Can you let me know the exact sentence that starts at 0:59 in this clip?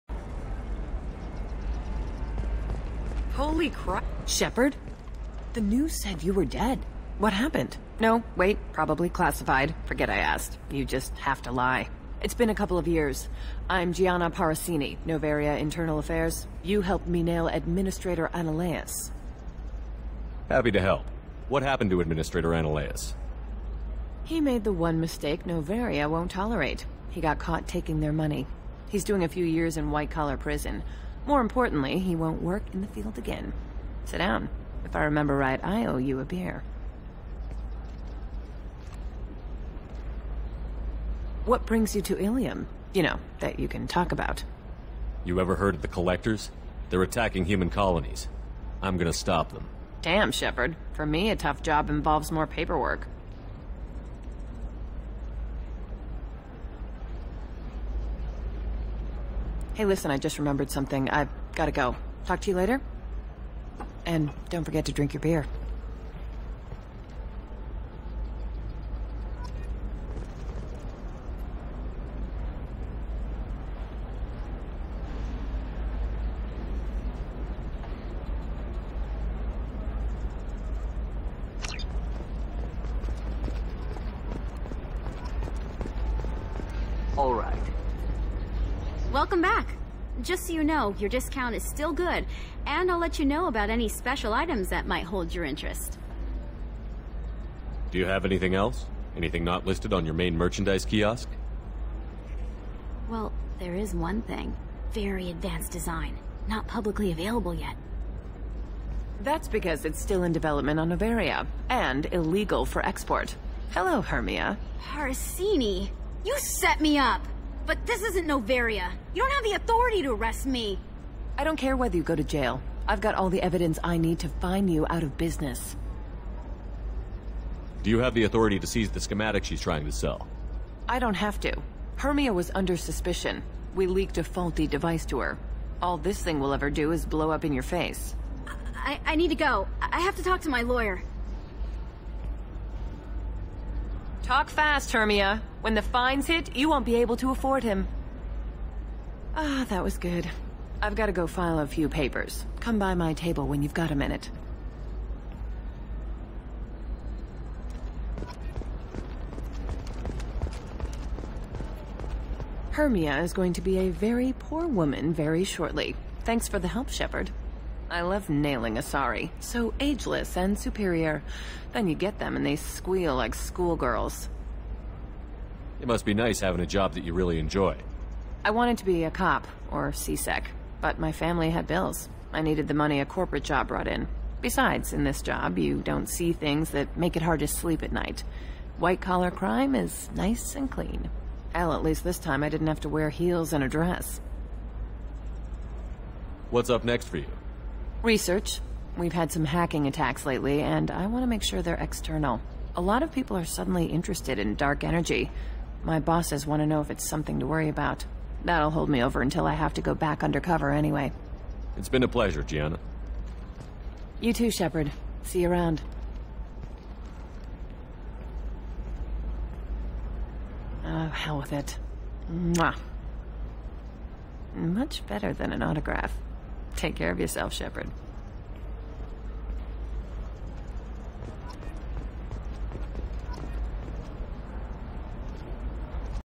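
Hey, listen, I just remembered something.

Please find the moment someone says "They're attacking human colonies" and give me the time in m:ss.
0:46.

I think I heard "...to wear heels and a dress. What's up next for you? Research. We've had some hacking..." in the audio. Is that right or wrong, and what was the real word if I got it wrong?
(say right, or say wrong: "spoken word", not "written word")
right.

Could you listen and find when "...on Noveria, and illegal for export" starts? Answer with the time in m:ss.
1:50.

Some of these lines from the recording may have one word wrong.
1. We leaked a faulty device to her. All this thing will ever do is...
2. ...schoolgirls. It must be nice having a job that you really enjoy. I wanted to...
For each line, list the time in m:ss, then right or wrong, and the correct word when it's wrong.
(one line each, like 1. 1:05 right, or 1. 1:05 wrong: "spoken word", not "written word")
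1. 2:13 right
2. 2:53 right.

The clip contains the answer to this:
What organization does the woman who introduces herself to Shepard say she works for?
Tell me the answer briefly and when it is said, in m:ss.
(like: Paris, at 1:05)
Noveria Internal Affairs, at 0:15.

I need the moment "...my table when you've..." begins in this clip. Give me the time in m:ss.
2:32.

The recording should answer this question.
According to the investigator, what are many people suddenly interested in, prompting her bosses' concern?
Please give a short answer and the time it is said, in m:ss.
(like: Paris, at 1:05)
Dark energy, at 3:24.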